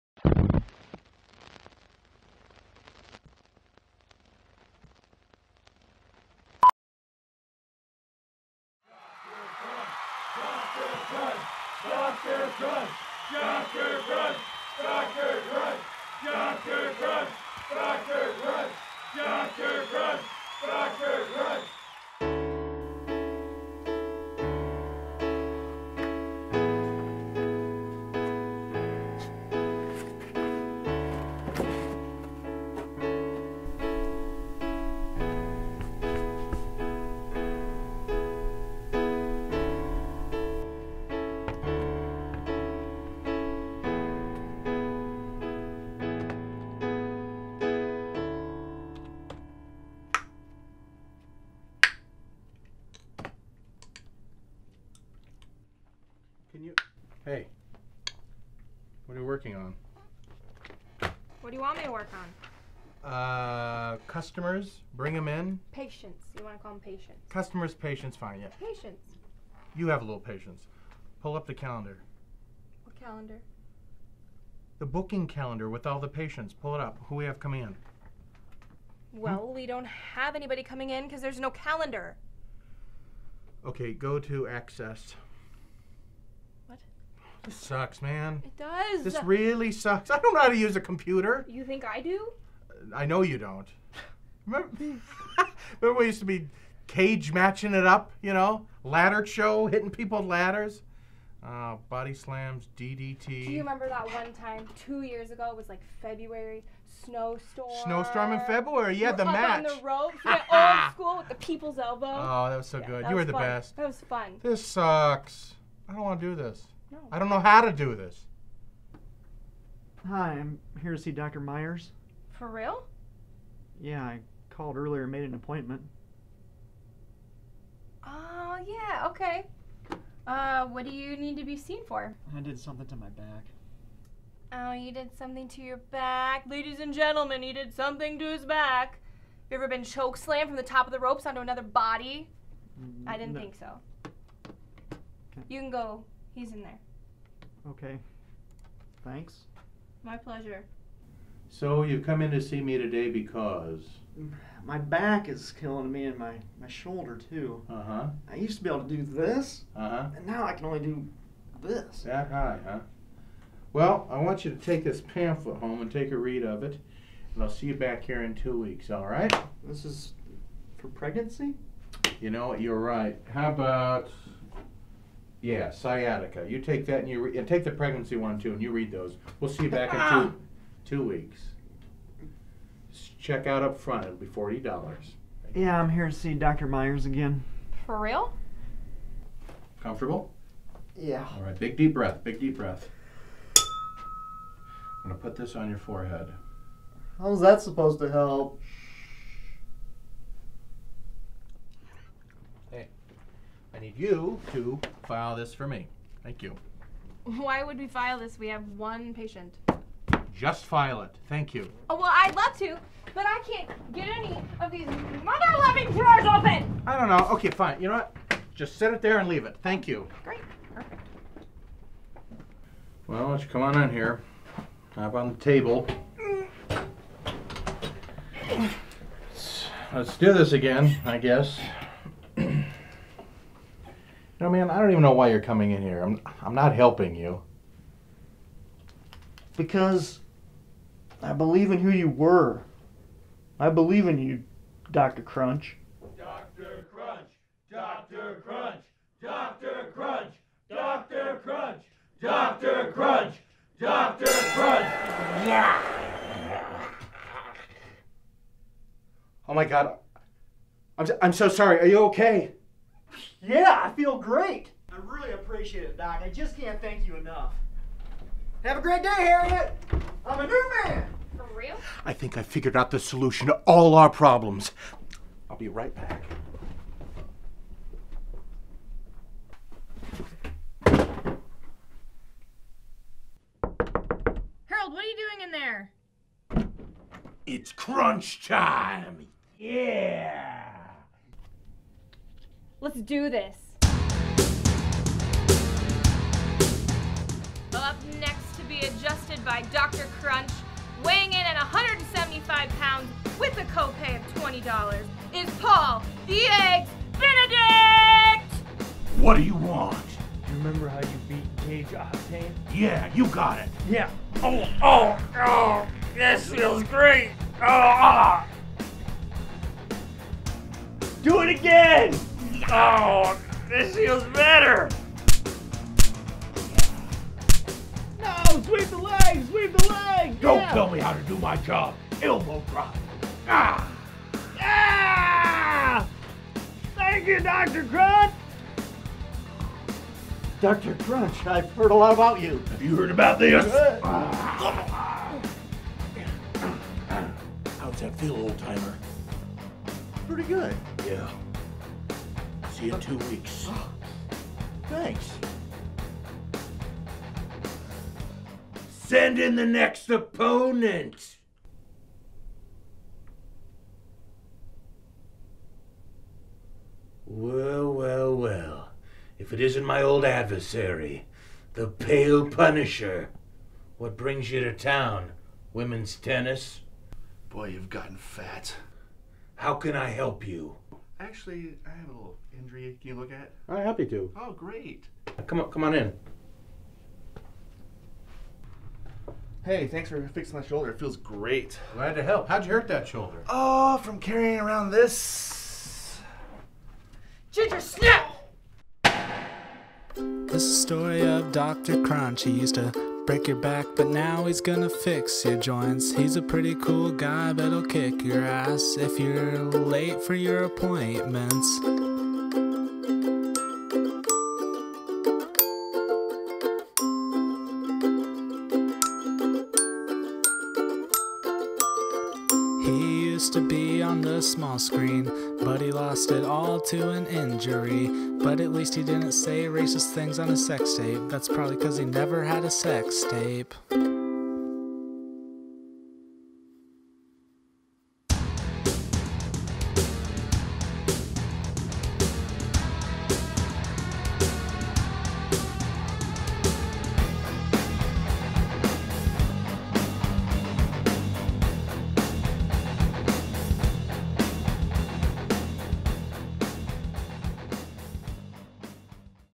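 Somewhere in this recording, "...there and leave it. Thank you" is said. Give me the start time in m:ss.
3:39.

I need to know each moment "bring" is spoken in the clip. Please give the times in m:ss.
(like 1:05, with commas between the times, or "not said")
1:04, 6:14.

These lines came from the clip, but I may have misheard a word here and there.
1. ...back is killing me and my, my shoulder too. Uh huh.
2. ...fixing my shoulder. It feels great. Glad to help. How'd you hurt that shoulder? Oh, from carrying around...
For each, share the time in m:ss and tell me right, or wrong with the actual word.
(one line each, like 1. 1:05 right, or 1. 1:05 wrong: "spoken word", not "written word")
1. 2:34 right
2. 6:30 right.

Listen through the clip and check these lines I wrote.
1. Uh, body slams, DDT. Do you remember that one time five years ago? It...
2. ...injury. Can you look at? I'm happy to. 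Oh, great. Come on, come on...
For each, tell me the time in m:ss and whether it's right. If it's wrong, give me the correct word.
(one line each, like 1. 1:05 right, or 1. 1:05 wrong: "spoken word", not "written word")
1. 1:41 wrong: "two", not "five"
2. 6:22 right.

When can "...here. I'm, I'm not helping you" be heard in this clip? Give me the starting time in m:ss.
3:55.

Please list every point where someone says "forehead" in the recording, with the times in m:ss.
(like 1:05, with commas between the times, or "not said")
3:15.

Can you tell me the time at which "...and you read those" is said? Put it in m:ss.
2:58.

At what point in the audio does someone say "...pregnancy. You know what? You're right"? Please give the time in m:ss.
2:50.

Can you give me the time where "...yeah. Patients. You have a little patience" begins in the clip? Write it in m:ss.
1:08.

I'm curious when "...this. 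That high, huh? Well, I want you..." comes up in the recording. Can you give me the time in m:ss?
2:41.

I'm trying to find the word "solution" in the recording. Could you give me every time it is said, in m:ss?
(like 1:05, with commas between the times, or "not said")
4:32.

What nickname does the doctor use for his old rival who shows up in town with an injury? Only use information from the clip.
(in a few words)
the Pale Punisher.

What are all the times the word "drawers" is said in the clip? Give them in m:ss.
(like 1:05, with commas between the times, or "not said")
3:35.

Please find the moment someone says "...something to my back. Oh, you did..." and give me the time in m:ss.
2:12.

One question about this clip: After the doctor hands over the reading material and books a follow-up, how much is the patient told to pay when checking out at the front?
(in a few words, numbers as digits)
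$40.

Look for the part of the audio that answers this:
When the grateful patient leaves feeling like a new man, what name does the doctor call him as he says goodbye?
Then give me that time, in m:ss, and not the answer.
4:29.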